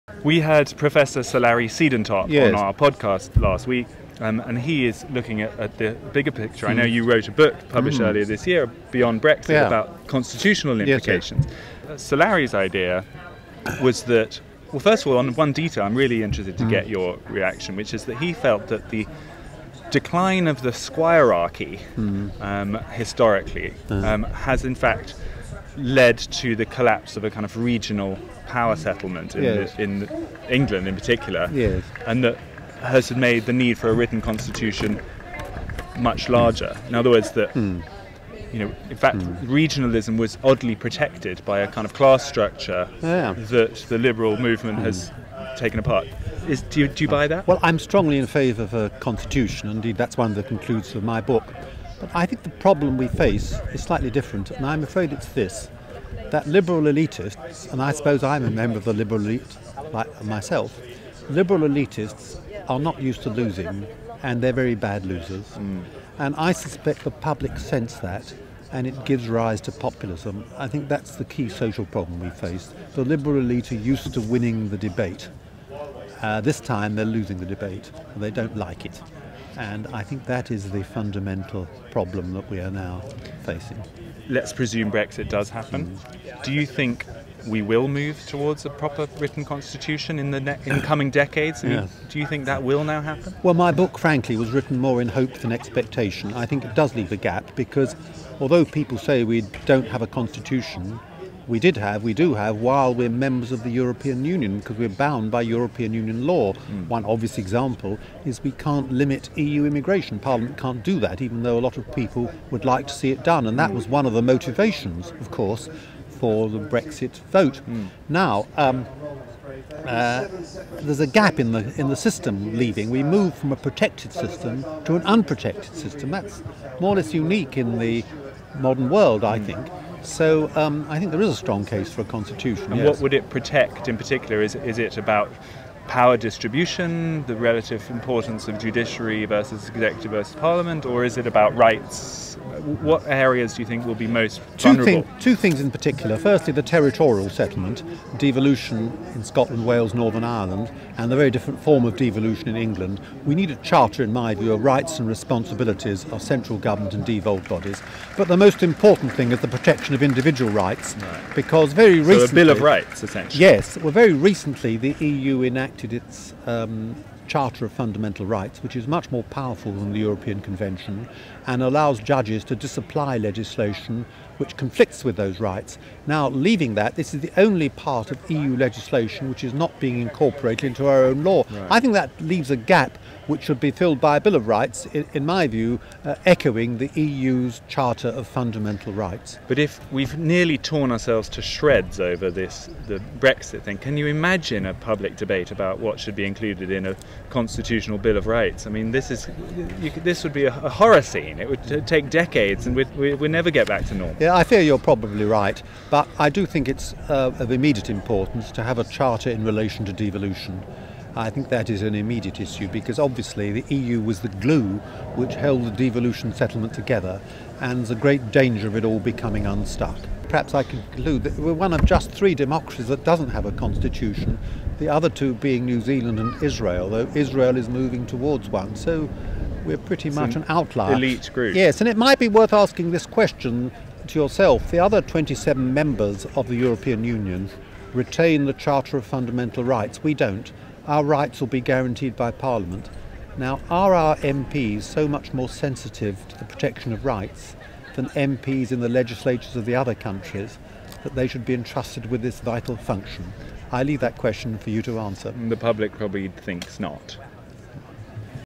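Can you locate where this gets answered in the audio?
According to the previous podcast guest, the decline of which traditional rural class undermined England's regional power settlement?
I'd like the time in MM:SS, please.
00:20.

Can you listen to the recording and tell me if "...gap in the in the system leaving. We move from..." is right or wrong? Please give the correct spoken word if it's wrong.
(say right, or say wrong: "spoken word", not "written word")
right.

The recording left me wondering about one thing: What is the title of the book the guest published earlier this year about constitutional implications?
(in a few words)
Beyond Brexit.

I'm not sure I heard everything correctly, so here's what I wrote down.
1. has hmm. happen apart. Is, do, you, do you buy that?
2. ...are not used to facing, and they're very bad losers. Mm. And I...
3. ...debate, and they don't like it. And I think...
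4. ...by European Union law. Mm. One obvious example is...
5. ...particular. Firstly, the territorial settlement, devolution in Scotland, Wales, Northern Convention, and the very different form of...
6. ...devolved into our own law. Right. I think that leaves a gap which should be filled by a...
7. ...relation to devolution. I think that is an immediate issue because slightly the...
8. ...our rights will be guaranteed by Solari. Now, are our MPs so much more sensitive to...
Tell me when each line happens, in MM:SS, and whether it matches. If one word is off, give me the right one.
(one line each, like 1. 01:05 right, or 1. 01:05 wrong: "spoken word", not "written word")
1. 00:44 wrong: "taken", not "happen"
2. 01:02 wrong: "losing", not "facing"
3. 01:17 right
4. 01:45 right
5. 02:25 wrong: "Ireland", not "Convention"
6. 03:00 wrong: "incorporated", not "devolved"
7. 03:29 wrong: "obviously", not "slightly"
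8. 04:00 wrong: "Parliament", not "Solari".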